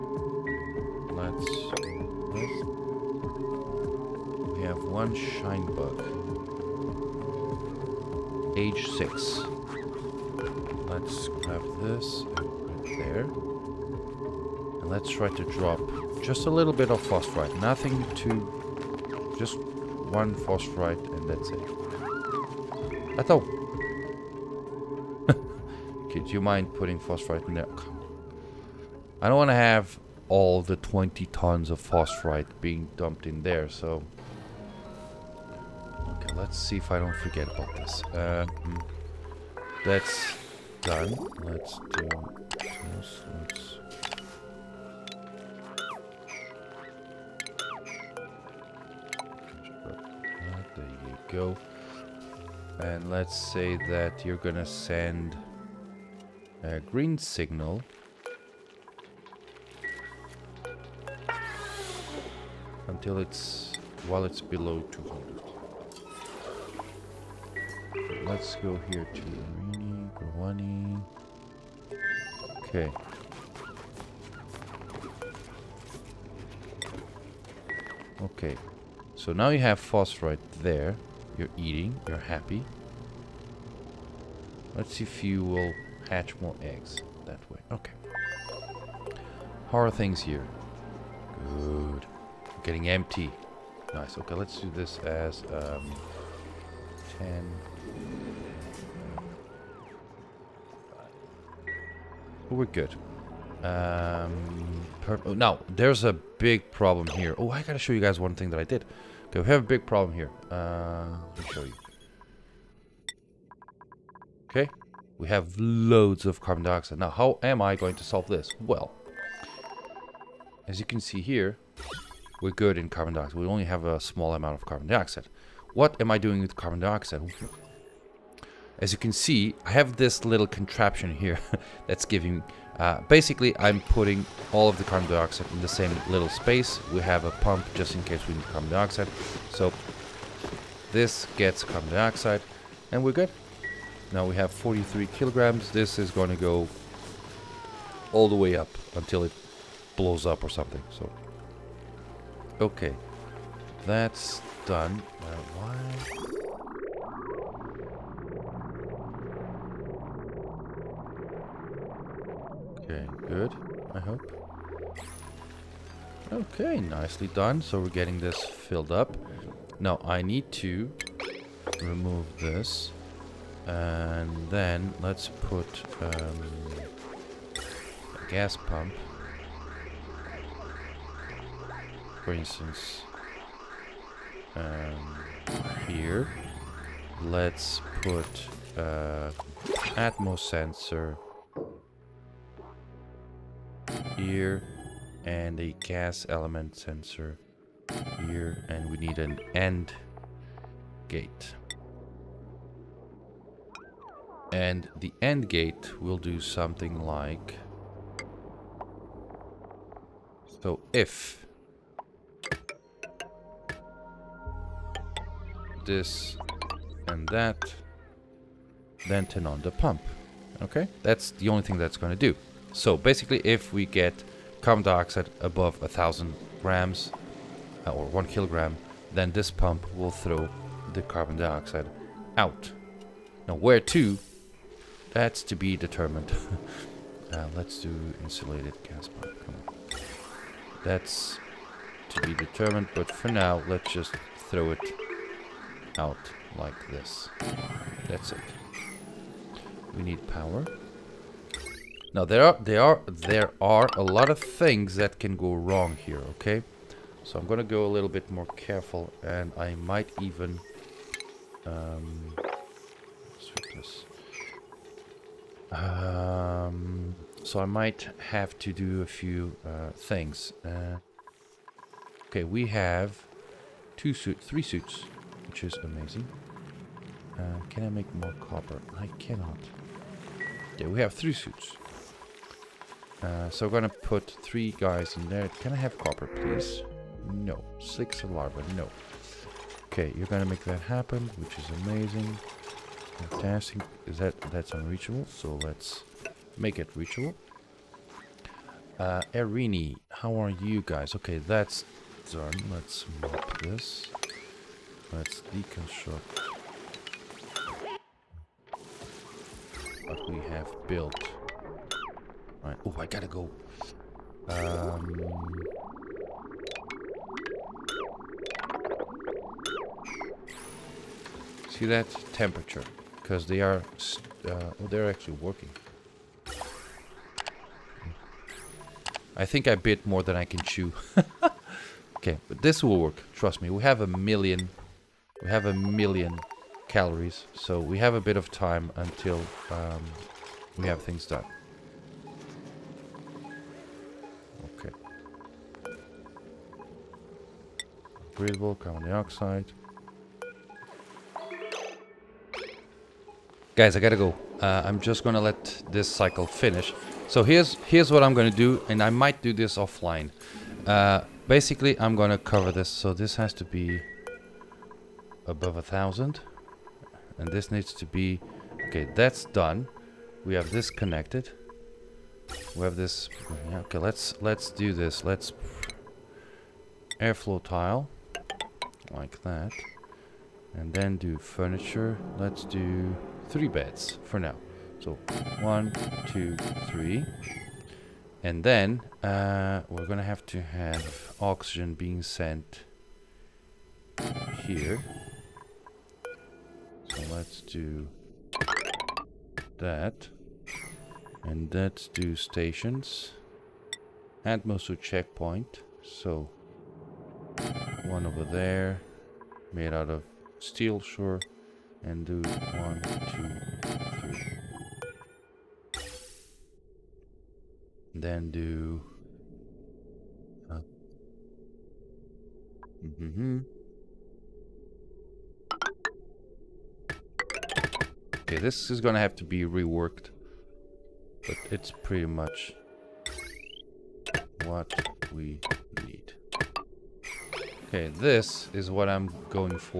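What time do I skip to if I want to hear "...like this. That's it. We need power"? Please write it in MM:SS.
04:06.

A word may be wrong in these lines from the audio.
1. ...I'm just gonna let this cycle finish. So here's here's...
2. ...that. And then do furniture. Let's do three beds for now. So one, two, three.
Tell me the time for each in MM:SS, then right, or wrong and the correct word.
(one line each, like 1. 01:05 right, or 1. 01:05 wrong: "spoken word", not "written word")
1. 05:54 right
2. 06:19 right.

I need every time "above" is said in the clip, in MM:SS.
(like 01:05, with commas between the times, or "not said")
03:45, 06:05.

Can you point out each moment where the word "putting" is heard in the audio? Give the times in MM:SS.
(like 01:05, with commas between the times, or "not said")
00:26, 02:13.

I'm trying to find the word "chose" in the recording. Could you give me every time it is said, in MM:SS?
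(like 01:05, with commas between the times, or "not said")
not said.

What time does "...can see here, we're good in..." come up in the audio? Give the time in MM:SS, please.
02:00.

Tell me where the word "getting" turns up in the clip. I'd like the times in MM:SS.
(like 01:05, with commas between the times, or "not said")
01:32, 02:47.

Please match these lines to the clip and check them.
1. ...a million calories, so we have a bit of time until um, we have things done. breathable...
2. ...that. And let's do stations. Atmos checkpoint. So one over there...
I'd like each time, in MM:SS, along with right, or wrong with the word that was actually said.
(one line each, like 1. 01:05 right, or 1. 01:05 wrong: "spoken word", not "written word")
1. 05:35 right
2. 06:39 right.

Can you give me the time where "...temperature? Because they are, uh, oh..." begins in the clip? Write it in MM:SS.
05:22.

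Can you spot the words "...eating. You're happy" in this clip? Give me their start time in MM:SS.
01:21.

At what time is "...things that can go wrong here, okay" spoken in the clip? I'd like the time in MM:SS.
04:14.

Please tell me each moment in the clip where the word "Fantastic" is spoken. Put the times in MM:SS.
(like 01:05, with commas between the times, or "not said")
04:53.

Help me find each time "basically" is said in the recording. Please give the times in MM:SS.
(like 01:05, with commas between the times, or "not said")
02:13, 03:42, 06:01.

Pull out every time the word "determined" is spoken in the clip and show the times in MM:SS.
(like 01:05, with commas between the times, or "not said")
03:55, 04:02.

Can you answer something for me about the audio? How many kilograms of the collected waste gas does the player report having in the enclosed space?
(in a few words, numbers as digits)
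43 kilograms.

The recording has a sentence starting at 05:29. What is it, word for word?
I think I bit more than I can chew.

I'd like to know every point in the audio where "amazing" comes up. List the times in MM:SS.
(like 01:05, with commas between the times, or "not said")
04:35, 04:51.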